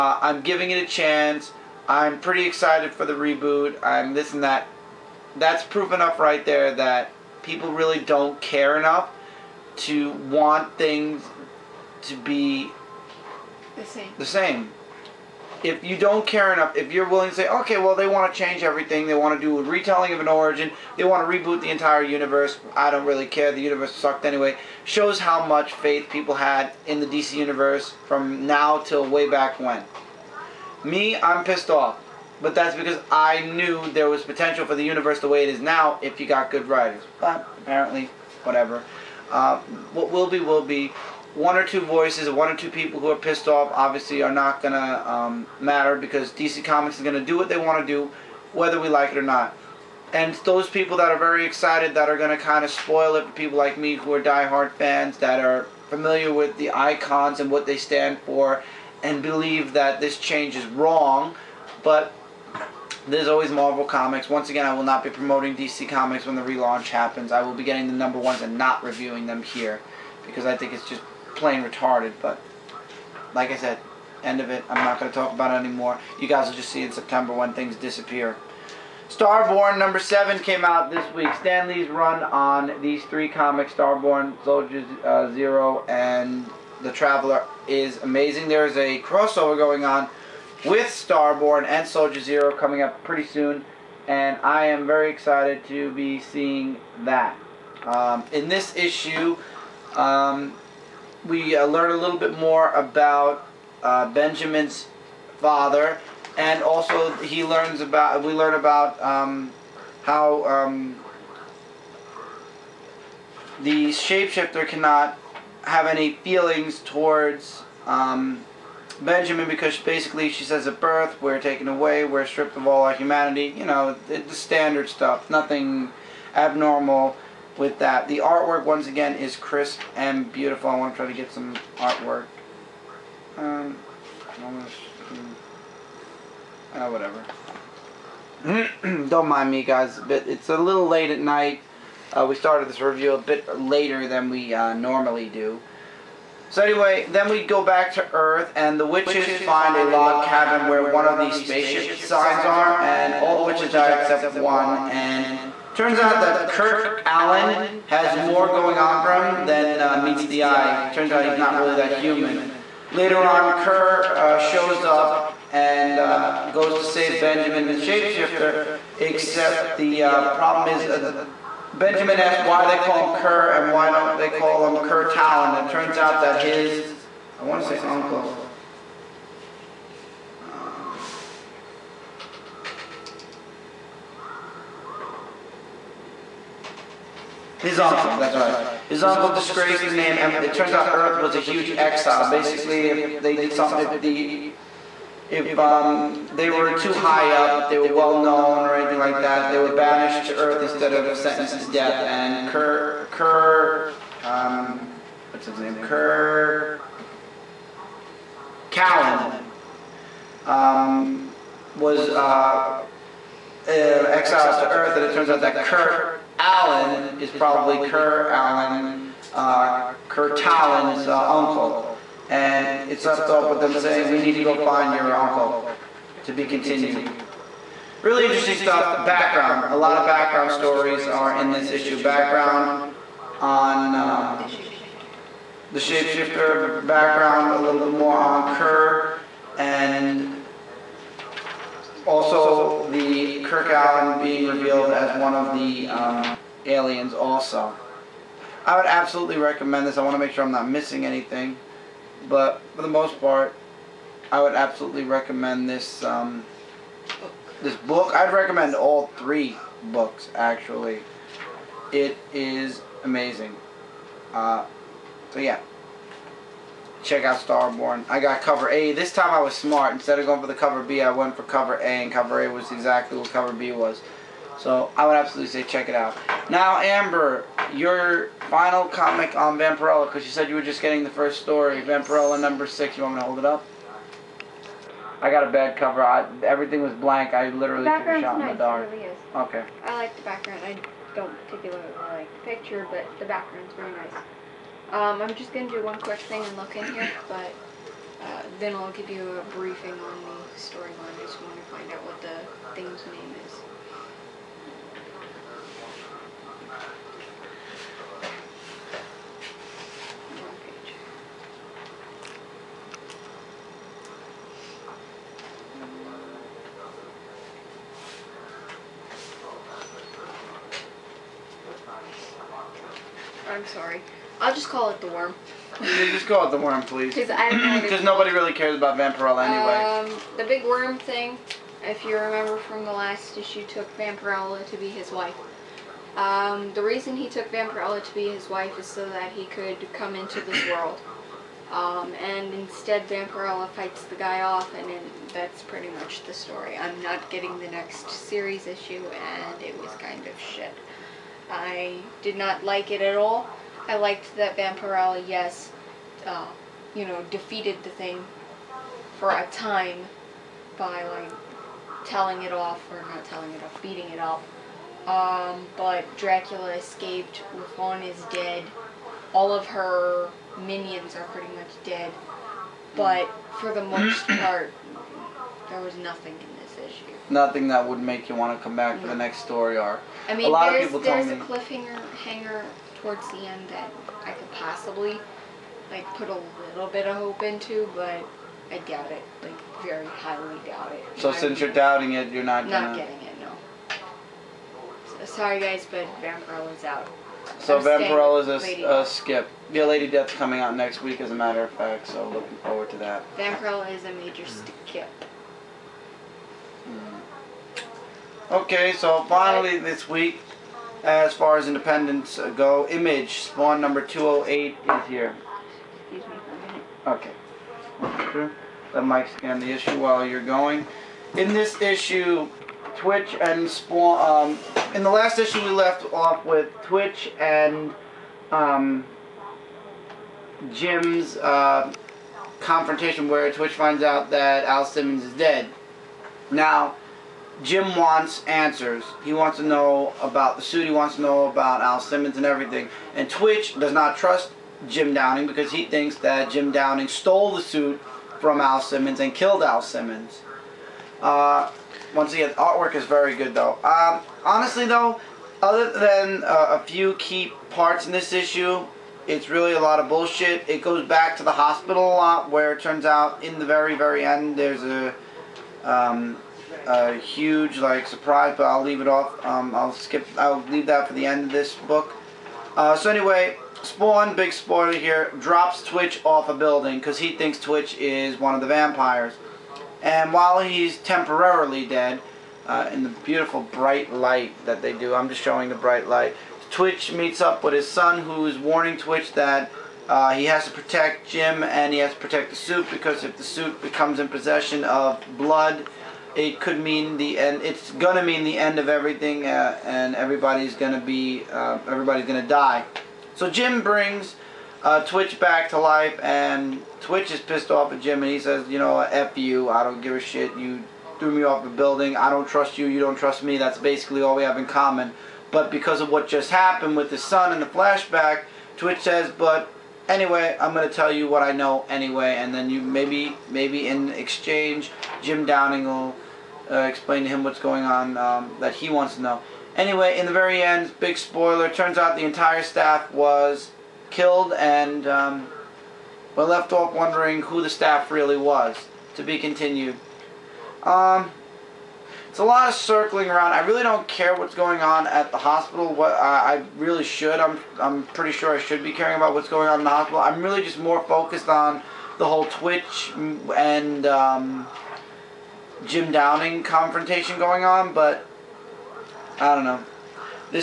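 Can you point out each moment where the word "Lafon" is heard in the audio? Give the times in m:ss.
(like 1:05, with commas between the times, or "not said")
6:07.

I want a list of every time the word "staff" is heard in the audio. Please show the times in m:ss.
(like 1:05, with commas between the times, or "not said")
8:52, 8:57.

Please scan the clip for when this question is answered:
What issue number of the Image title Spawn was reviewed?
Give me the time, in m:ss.
6:53.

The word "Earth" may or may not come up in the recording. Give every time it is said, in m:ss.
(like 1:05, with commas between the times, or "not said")
2:28, 3:10, 3:20, 3:34.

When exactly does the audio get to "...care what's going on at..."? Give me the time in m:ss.
9:04.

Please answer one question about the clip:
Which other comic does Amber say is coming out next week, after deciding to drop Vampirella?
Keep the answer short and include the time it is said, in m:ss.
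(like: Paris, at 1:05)
Lady Death, at 6:39.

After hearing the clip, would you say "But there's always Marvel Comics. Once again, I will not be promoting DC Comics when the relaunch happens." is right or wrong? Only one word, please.
right.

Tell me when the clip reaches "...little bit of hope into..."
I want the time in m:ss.
6:26.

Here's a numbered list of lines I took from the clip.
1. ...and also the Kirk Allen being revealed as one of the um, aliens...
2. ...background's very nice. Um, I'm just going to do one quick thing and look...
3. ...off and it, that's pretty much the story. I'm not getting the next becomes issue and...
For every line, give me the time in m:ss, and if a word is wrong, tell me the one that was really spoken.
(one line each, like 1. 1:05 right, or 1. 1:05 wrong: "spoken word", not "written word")
1. 3:59 right
2. 4:53 right
3. 5:44 wrong: "series", not "becomes".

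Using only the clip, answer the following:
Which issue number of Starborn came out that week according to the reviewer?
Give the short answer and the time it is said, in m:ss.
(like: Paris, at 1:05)
7, at 1:19.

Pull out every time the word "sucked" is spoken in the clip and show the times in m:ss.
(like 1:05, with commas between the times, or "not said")
0:23.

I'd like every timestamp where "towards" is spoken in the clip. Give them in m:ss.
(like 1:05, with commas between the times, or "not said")
1:56, 6:23.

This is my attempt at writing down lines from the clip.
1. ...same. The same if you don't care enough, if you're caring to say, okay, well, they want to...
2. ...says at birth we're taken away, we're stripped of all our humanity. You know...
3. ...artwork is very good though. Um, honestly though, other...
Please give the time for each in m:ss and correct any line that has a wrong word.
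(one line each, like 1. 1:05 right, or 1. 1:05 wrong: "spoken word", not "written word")
1. 0:13 wrong: "willing", not "caring"
2. 2:00 right
3. 7:32 right.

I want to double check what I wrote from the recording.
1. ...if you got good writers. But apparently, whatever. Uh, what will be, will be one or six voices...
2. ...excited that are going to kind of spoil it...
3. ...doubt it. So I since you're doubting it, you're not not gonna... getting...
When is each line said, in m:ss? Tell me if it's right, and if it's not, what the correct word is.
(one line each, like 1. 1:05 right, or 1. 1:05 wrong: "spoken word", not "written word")
1. 0:35 wrong: "two", not "six"
2. 0:51 right
3. 6:30 right.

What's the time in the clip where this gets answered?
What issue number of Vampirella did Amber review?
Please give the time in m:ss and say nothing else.
4:41.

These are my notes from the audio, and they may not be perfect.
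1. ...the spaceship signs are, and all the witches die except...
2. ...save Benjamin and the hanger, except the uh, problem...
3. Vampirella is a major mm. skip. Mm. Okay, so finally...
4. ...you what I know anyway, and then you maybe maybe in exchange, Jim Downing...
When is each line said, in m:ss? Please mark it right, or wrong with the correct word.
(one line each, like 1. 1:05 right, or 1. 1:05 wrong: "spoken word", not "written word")
1. 2:31 right
2. 2:46 wrong: "shapeshifter", not "hanger"
3. 6:43 right
4. 8:41 right.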